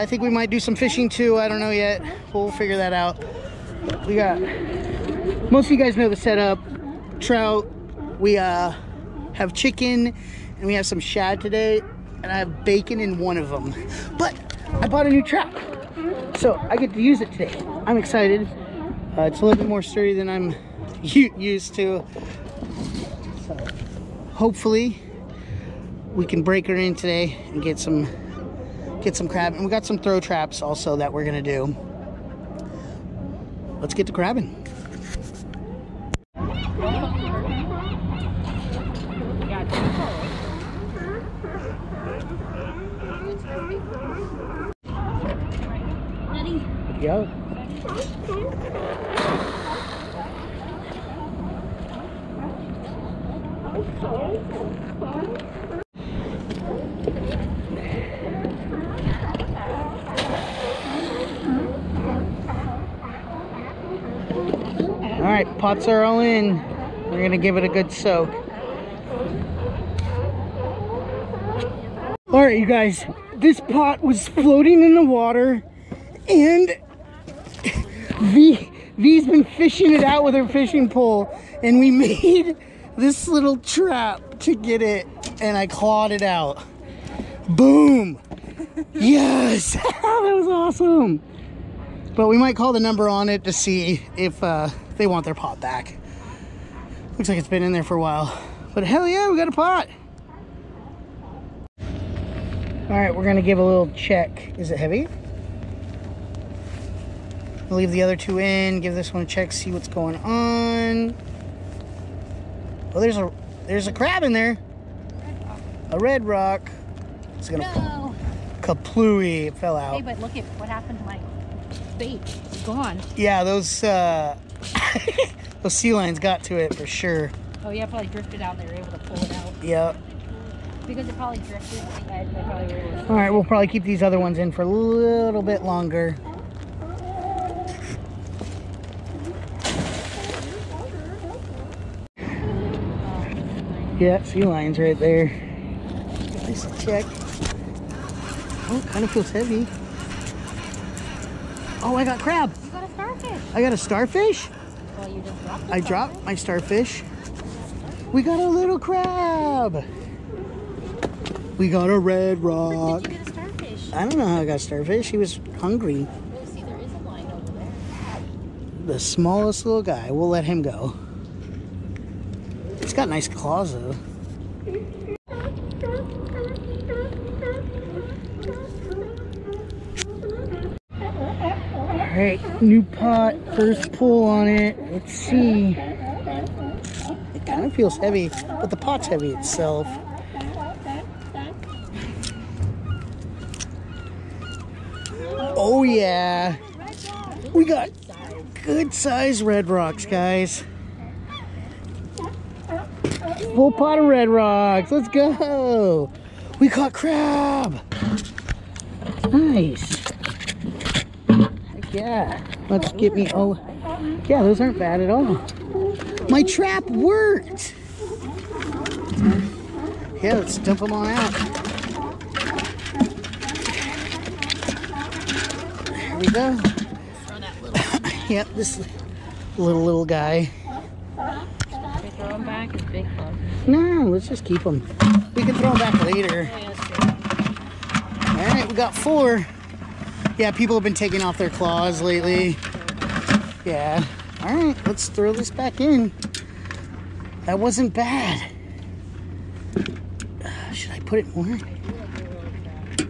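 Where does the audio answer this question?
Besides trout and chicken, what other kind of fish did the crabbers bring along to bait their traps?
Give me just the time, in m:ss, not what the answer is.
0:10.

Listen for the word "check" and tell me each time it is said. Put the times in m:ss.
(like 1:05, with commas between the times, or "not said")
1:43, 1:49, 2:26.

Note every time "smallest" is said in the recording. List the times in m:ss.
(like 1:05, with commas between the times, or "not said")
2:48.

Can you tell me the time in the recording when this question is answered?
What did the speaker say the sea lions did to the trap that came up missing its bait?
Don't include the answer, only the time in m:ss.
2:05.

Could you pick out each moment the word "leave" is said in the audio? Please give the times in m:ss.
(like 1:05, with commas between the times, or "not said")
1:47.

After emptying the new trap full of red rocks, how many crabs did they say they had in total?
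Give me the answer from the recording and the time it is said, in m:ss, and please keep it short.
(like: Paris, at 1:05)
4, at 3:58.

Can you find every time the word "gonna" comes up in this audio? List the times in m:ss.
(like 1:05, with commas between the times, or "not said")
0:31, 1:07, 1:43, 1:57.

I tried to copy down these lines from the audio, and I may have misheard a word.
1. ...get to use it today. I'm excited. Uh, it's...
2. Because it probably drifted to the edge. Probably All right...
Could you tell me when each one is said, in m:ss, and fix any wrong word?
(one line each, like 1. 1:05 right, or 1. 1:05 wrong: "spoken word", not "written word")
1. 0:16 right
2. 2:10 right.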